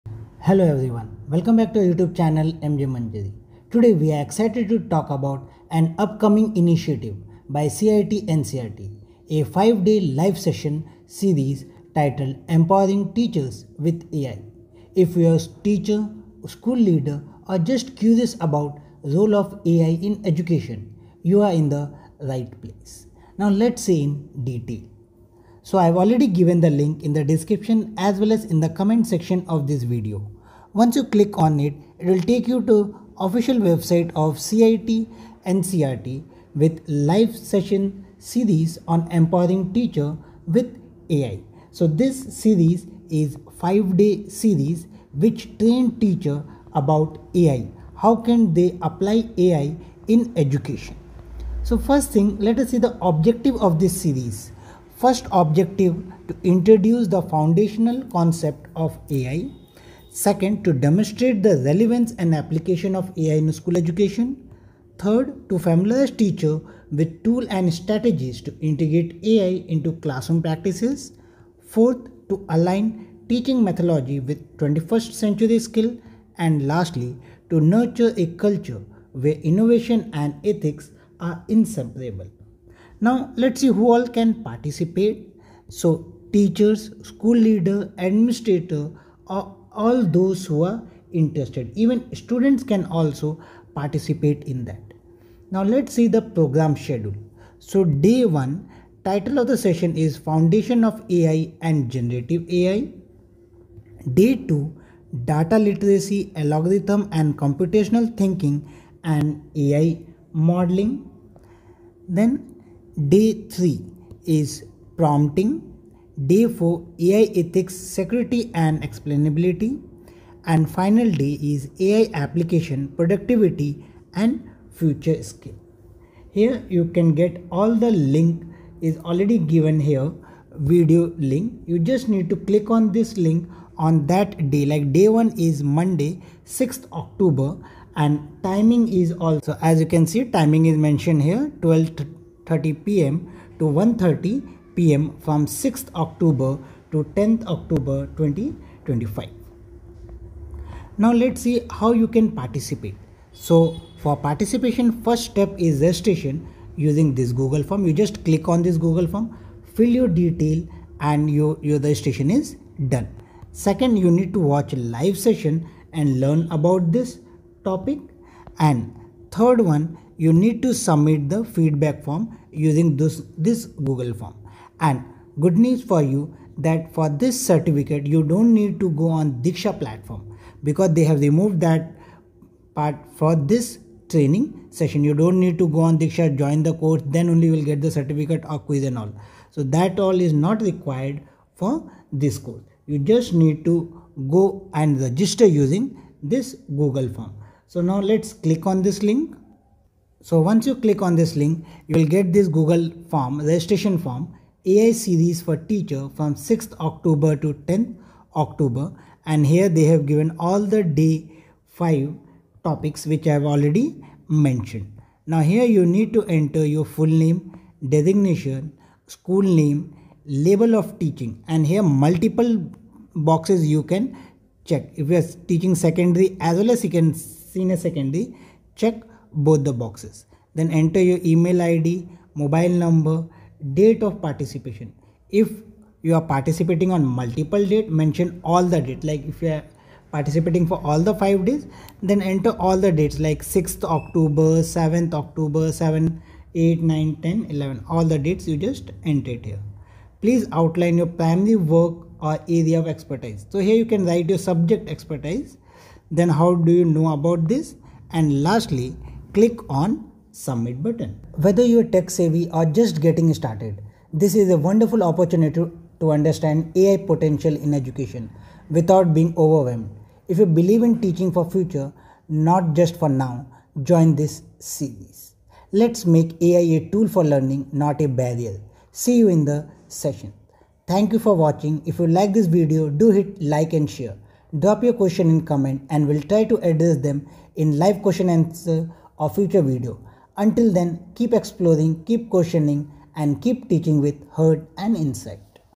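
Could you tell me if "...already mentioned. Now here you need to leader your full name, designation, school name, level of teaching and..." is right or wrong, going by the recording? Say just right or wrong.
wrong.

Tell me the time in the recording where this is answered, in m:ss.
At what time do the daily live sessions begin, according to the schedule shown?
2:21.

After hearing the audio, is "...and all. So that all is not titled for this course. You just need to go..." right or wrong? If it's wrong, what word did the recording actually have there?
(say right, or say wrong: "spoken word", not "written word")
wrong: "required", not "titled".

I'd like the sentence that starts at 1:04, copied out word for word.
Third, to familiarize teacher with tool and strategies to integrate AI into classroom practices.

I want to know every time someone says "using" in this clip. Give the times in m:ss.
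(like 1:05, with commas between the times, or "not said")
2:36, 2:52, 3:15.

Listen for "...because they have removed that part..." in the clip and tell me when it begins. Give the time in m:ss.
3:00.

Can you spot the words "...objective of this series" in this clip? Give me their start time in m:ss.
0:53.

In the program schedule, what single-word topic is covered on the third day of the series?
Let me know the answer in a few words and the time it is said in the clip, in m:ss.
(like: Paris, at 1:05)
Prompting, at 1:54.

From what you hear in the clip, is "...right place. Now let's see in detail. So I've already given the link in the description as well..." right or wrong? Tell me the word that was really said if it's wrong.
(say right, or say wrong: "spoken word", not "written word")
right.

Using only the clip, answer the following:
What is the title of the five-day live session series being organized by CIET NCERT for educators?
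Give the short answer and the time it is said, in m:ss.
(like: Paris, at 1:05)
Empowering Teachers with AI, at 0:12.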